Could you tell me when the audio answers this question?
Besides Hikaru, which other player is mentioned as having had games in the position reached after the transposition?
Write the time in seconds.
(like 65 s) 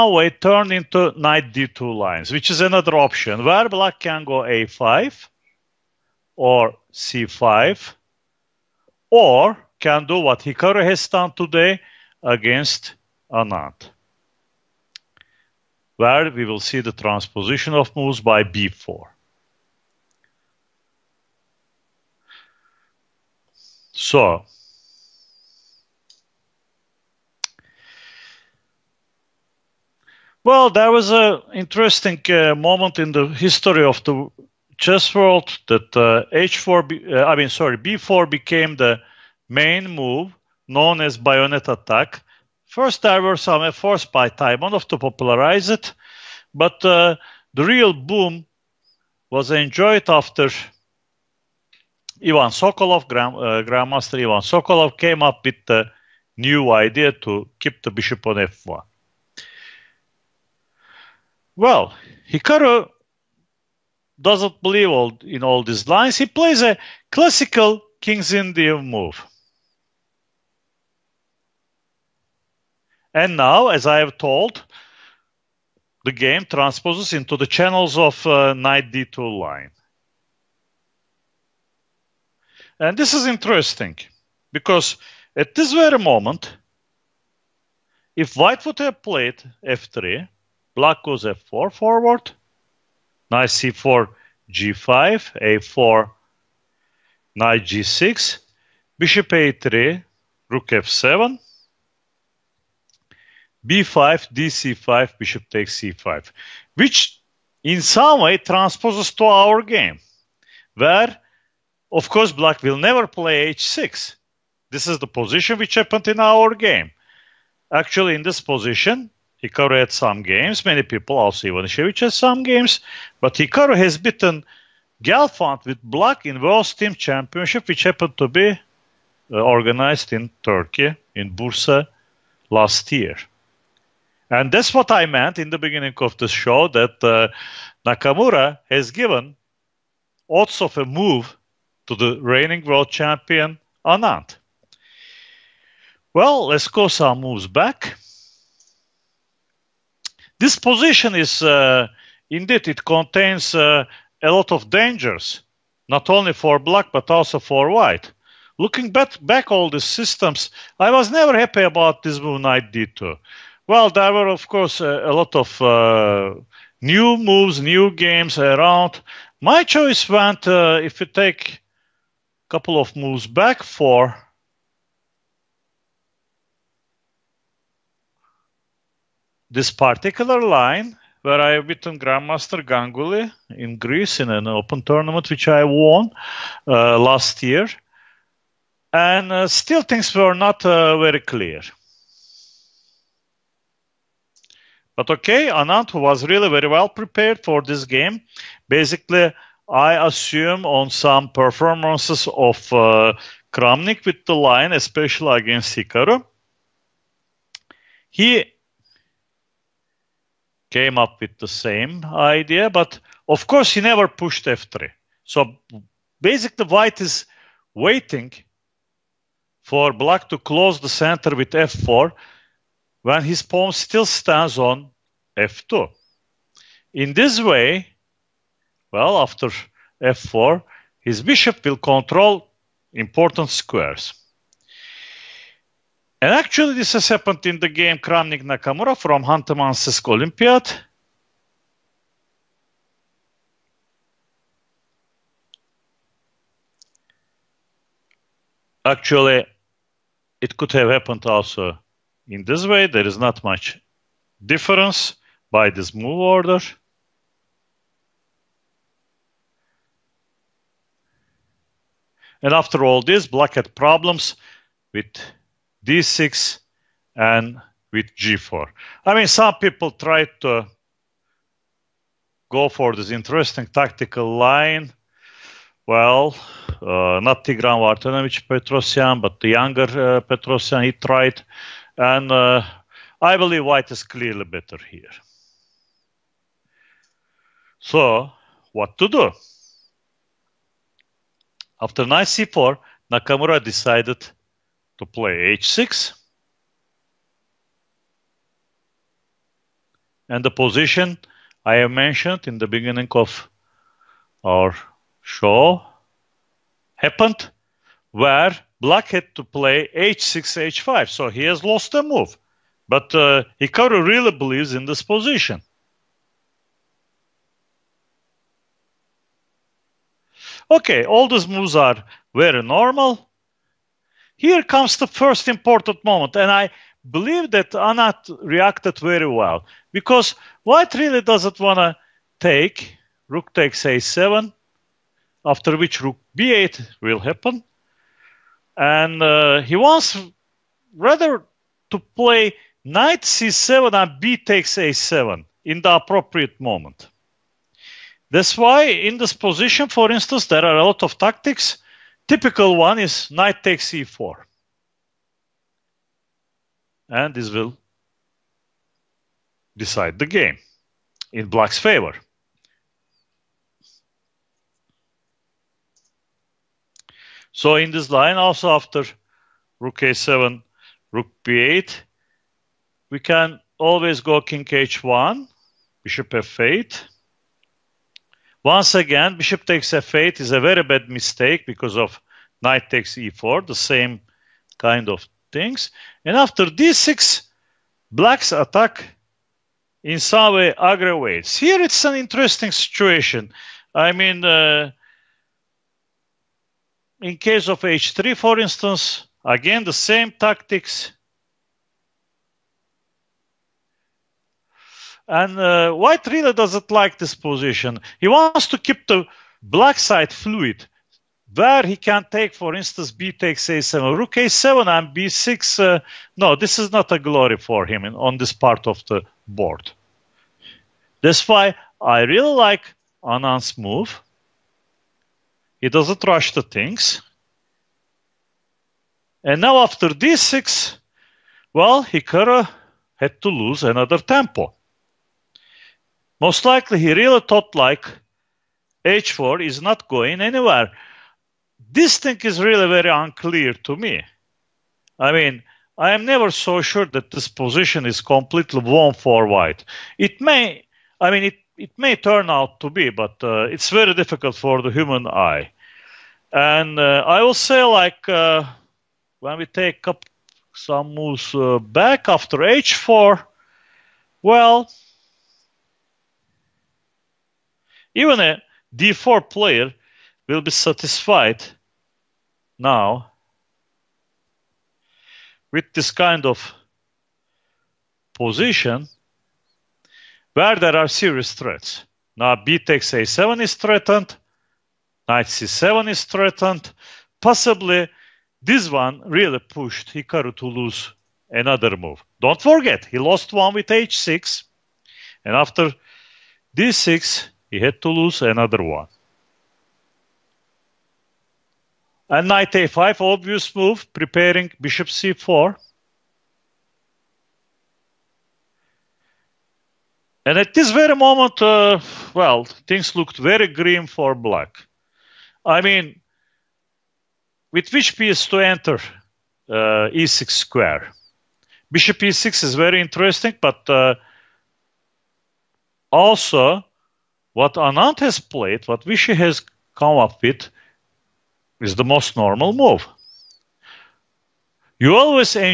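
121 s.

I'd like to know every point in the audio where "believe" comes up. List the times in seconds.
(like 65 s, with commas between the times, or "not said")
64 s, 283 s, 314 s, 327 s.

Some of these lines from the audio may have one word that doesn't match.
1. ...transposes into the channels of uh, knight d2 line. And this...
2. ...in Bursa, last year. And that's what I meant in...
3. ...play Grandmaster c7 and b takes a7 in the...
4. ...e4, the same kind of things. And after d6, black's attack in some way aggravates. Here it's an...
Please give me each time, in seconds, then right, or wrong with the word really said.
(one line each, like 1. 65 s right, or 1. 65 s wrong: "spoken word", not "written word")
1. 76 s right
2. 131 s right
3. 342 s wrong: "Knight", not "Grandmaster"
4. 383 s right.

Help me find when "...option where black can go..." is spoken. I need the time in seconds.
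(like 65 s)
2 s.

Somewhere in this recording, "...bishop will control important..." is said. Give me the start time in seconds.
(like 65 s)
231 s.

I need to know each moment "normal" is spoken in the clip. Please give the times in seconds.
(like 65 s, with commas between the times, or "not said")
322 s, 532 s.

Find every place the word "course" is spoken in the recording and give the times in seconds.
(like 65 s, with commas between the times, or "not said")
112 s, 164 s, 213 s.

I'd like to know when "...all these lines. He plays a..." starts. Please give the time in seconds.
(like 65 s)
65 s.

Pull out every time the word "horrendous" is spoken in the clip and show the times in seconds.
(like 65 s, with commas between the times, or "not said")
not said.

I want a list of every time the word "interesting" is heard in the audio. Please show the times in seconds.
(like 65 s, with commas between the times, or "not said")
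31 s, 83 s, 273 s, 392 s, 522 s.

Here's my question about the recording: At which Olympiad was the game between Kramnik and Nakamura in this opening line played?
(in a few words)
Khanty-Mansiysk.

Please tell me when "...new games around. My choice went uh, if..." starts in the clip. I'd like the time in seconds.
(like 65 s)
167 s.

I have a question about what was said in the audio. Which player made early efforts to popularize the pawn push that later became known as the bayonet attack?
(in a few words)
Taimanov.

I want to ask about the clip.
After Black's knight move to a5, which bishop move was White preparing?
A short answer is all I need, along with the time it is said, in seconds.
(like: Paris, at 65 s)
Bishop c4, at 504 s.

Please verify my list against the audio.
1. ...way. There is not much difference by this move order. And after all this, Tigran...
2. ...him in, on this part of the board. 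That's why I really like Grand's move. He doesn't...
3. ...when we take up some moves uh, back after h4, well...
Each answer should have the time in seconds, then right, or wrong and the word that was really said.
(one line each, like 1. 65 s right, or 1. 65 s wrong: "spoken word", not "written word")
1. 252 s wrong: "Black", not "Tigran"
2. 417 s wrong: "Anand", not "Grand"
3. 459 s right.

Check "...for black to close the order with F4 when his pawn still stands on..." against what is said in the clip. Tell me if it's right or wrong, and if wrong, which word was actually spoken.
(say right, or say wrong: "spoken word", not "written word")
wrong: "center", not "order".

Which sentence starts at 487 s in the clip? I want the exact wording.
Possibly this one really pushed Hikaru to lose another move.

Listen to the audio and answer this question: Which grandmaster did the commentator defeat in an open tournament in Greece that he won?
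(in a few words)
Ganguly.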